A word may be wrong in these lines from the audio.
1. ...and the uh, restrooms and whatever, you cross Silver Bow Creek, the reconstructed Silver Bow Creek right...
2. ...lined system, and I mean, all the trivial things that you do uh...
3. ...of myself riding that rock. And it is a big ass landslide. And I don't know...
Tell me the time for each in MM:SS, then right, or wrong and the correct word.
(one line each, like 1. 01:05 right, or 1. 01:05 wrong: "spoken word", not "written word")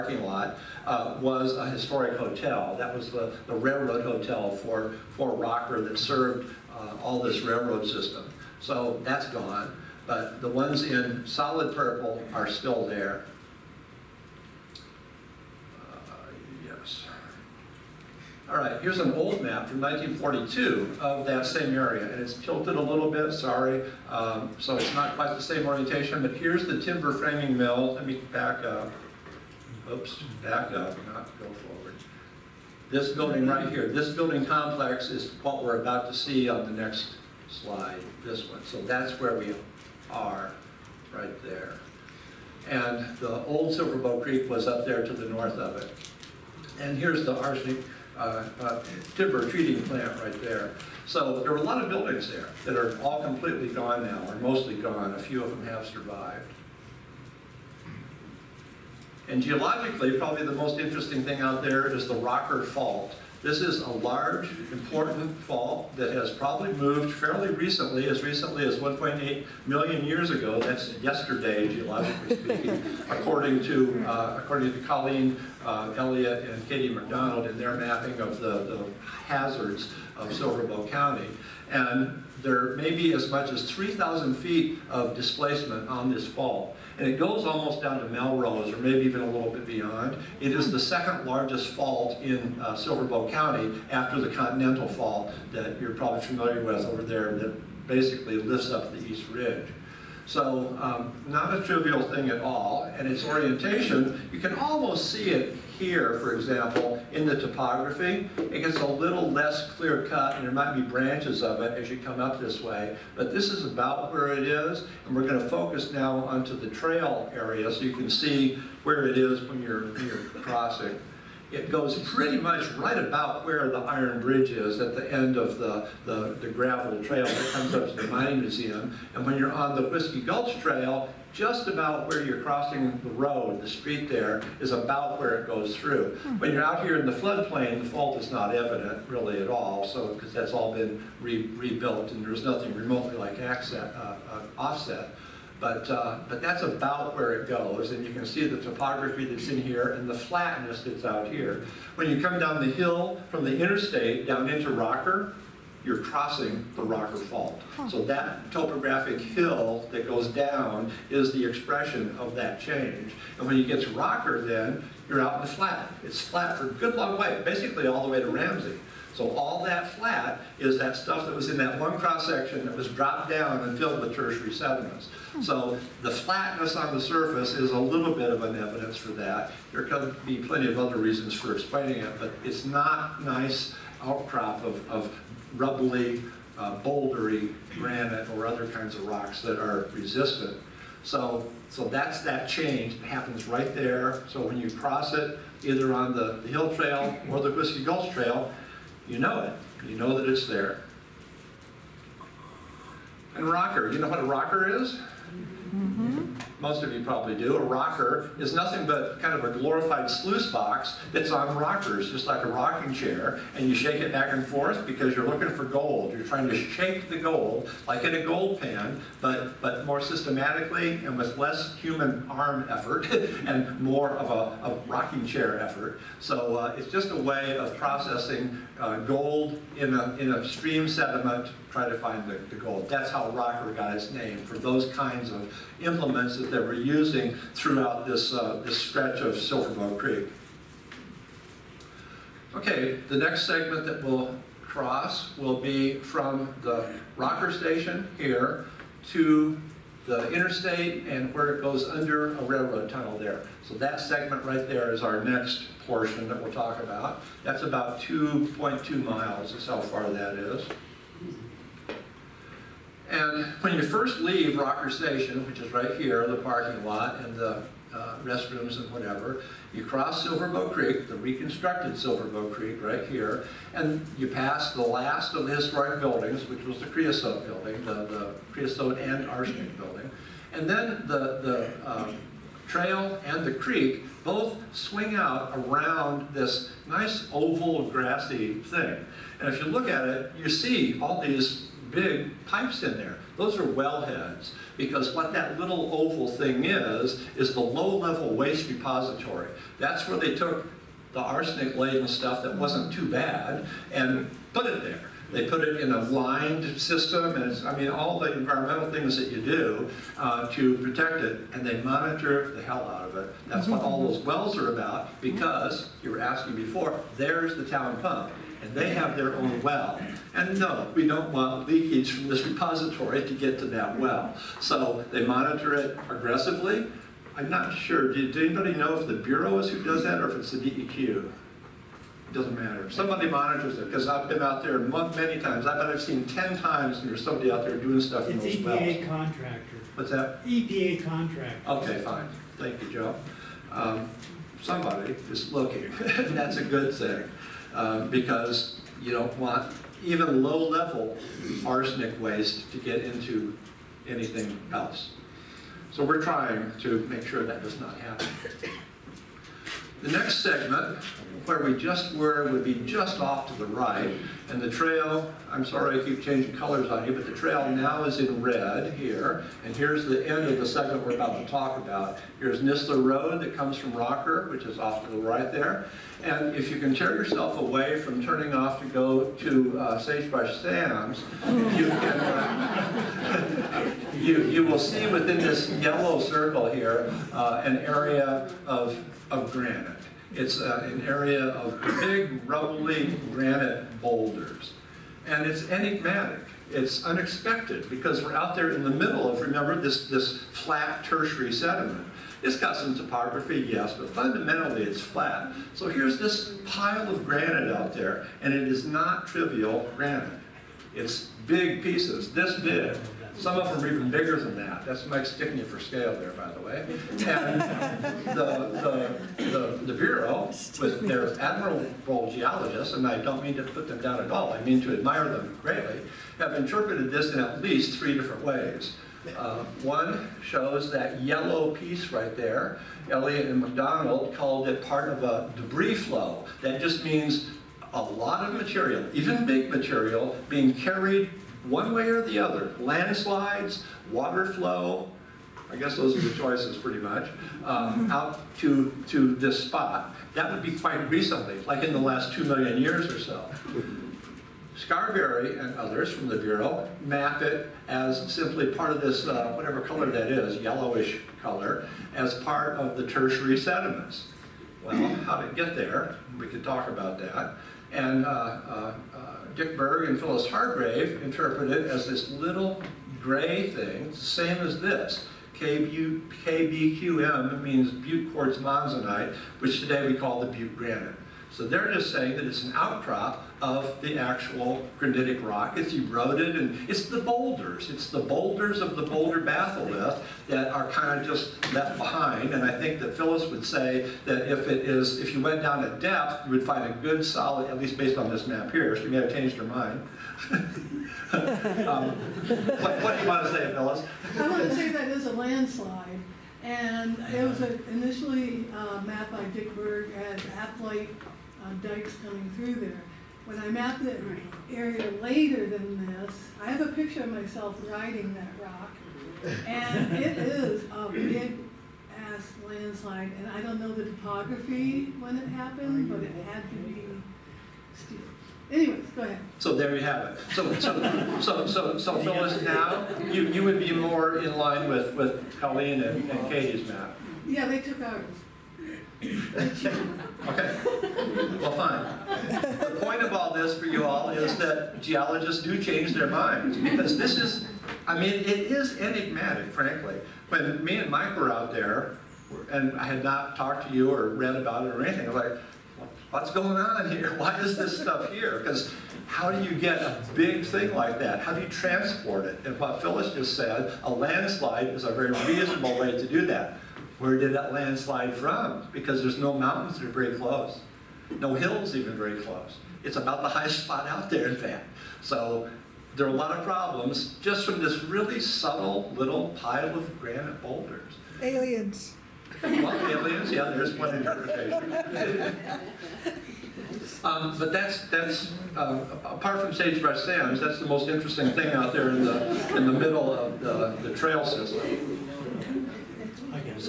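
1. 04:27 right
2. 05:06 wrong: "environmental", not "trivial"
3. 08:37 right.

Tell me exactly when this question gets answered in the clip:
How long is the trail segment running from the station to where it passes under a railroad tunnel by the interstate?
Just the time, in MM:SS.
04:18.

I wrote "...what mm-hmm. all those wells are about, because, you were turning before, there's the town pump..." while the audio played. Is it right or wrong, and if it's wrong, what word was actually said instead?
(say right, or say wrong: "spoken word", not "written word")
wrong: "asking", not "turning".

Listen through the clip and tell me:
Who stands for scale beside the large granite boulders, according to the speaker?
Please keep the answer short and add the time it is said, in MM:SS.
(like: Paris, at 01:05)
Mike Stickney, at 06:55.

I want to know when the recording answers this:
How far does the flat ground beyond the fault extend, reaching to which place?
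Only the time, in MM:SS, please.
02:48.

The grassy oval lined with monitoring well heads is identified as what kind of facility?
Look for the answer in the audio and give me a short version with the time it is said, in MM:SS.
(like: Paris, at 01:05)
Low-level waste repository, at 04:57.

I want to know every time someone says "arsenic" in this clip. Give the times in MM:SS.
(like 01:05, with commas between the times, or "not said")
00:47, 04:39, 05:01, 05:51.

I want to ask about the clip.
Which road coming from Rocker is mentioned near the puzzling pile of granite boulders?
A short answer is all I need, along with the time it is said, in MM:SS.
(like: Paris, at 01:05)
Nistler Road, at 06:12.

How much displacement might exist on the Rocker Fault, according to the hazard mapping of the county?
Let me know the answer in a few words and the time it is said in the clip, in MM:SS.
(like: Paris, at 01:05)
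3,000 feet, at 01:23.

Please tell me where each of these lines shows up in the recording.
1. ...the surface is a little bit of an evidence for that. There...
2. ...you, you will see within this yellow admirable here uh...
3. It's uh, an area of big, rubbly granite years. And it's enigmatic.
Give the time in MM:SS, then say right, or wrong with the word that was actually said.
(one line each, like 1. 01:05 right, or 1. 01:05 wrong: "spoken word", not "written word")
1. 02:56 right
2. 06:24 wrong: "circle", not "admirable"
3. 06:30 wrong: "boulders", not "years".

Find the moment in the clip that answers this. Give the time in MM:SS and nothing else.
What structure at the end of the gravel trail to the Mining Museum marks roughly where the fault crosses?
02:03.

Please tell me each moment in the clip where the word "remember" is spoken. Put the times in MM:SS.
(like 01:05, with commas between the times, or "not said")
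06:39.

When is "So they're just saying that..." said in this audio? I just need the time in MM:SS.
08:01.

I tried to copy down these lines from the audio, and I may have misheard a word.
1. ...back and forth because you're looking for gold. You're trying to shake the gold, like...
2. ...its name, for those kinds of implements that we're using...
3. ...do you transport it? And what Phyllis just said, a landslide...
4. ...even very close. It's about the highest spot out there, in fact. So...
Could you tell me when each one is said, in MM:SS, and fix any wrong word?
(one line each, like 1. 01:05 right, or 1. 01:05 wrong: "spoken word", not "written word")
1. 03:34 right
2. 03:53 right
3. 09:21 right
4. 09:31 right.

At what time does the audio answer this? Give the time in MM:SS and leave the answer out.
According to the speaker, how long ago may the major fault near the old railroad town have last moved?
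01:08.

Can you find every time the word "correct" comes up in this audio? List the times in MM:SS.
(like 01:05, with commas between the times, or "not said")
not said.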